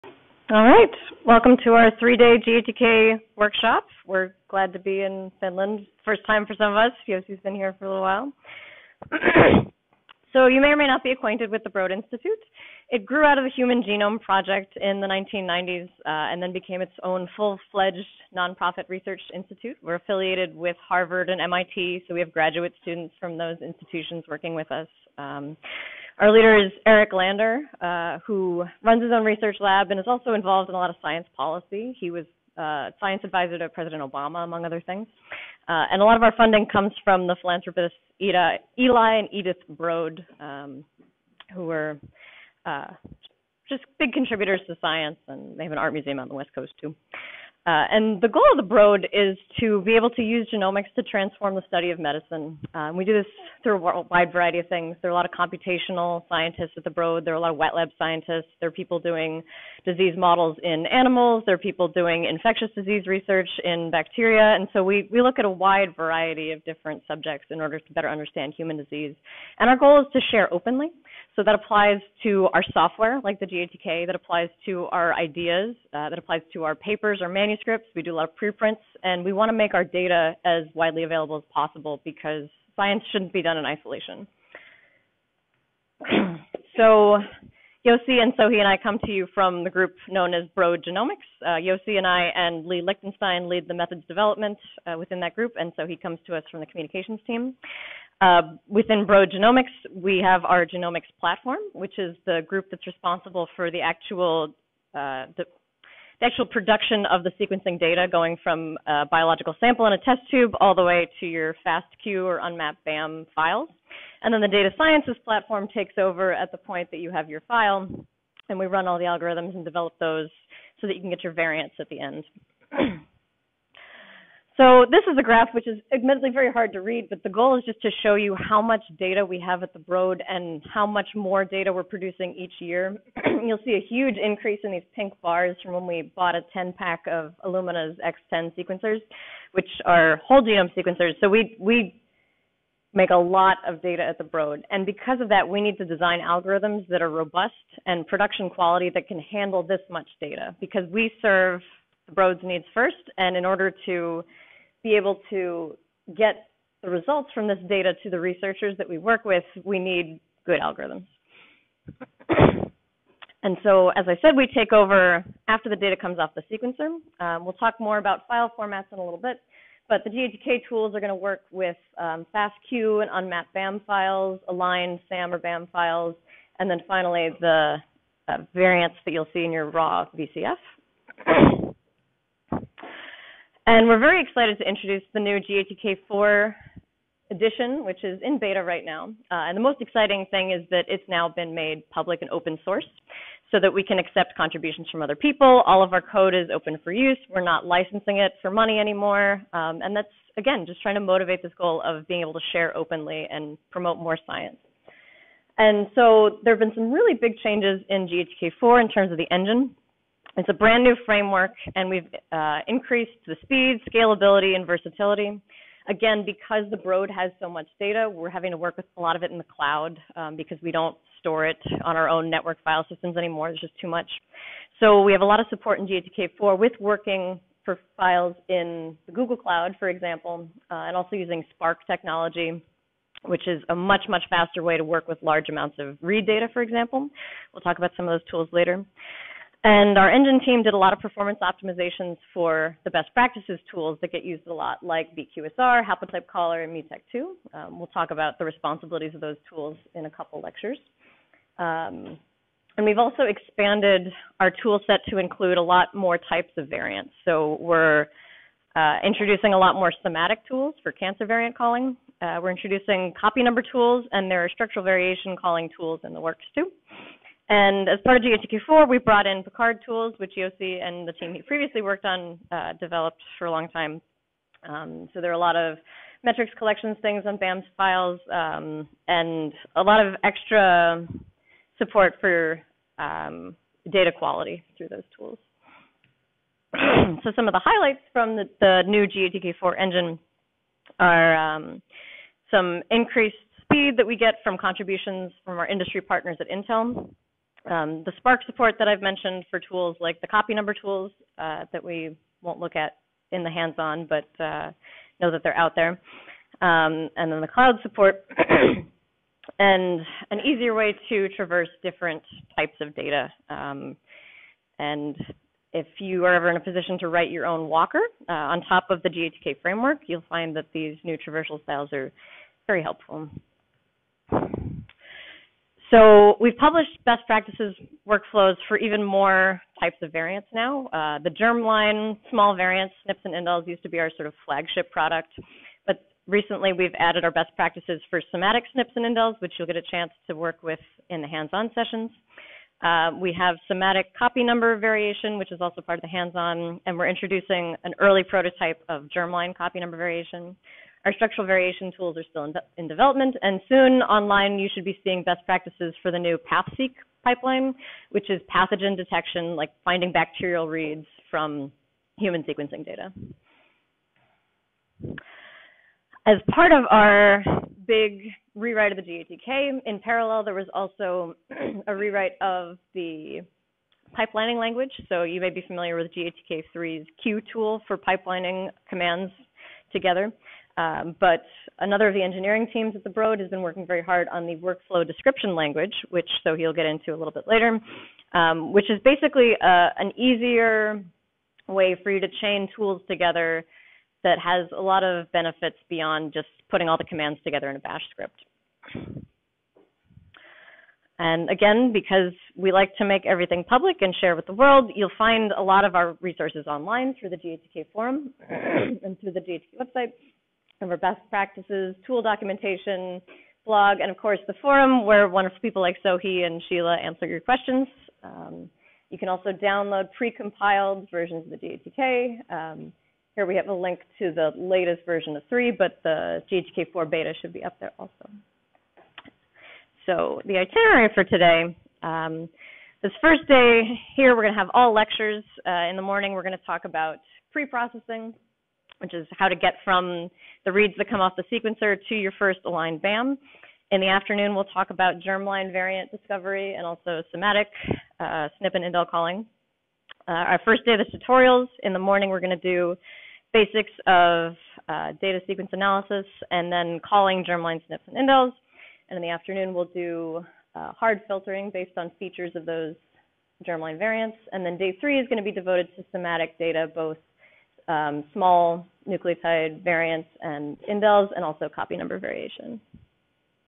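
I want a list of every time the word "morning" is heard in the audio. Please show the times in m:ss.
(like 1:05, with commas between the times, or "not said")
7:16, 7:31.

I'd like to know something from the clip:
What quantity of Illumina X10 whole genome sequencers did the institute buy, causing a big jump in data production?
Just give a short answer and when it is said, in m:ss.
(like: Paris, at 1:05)
10-pack, at 2:16.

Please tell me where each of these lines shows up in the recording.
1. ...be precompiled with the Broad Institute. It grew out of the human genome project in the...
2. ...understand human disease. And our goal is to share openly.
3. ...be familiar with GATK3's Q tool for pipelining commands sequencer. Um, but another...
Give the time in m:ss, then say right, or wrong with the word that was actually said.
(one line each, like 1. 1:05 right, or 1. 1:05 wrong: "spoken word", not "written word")
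1. 0:11 wrong: "acquainted", not "precompiled"
2. 1:08 right
3. 6:15 wrong: "together", not "sequencer".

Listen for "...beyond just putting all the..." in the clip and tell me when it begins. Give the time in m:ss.
6:35.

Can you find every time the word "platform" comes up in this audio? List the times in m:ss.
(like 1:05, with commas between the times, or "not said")
1:41, 1:55.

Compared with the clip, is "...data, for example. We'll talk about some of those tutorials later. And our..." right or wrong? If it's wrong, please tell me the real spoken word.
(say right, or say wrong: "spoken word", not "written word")
wrong: "tools", not "tutorials".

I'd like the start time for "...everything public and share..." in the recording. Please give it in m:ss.
6:43.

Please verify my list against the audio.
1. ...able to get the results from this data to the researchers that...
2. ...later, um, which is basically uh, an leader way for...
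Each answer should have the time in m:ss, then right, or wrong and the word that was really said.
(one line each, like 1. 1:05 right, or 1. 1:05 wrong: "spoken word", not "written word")
1. 2:34 right
2. 6:27 wrong: "easier", not "leader".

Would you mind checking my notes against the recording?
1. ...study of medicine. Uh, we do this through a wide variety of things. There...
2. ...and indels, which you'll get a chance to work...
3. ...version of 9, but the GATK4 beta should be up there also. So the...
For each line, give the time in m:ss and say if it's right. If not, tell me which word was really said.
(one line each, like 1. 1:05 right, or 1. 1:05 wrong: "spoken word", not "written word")
1. 0:51 right
2. 5:38 right
3. 7:05 wrong: "3", not "9".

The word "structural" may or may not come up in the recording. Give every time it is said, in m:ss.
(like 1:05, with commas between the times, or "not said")
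4:24, 5:51.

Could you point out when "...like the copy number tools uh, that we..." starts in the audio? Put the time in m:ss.
4:59.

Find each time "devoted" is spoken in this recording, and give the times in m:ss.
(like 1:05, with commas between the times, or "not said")
7:45.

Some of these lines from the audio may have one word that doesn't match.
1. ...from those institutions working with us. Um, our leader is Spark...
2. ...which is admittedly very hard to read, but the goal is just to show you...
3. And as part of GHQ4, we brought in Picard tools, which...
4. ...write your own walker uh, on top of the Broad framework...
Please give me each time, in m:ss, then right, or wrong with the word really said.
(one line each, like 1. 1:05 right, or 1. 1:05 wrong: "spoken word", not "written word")
1. 0:23 wrong: "Eric", not "Spark"
2. 2:05 right
3. 4:27 right
4. 5:17 wrong: "GATK", not "Broad".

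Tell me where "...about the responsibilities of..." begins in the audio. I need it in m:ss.
4:08.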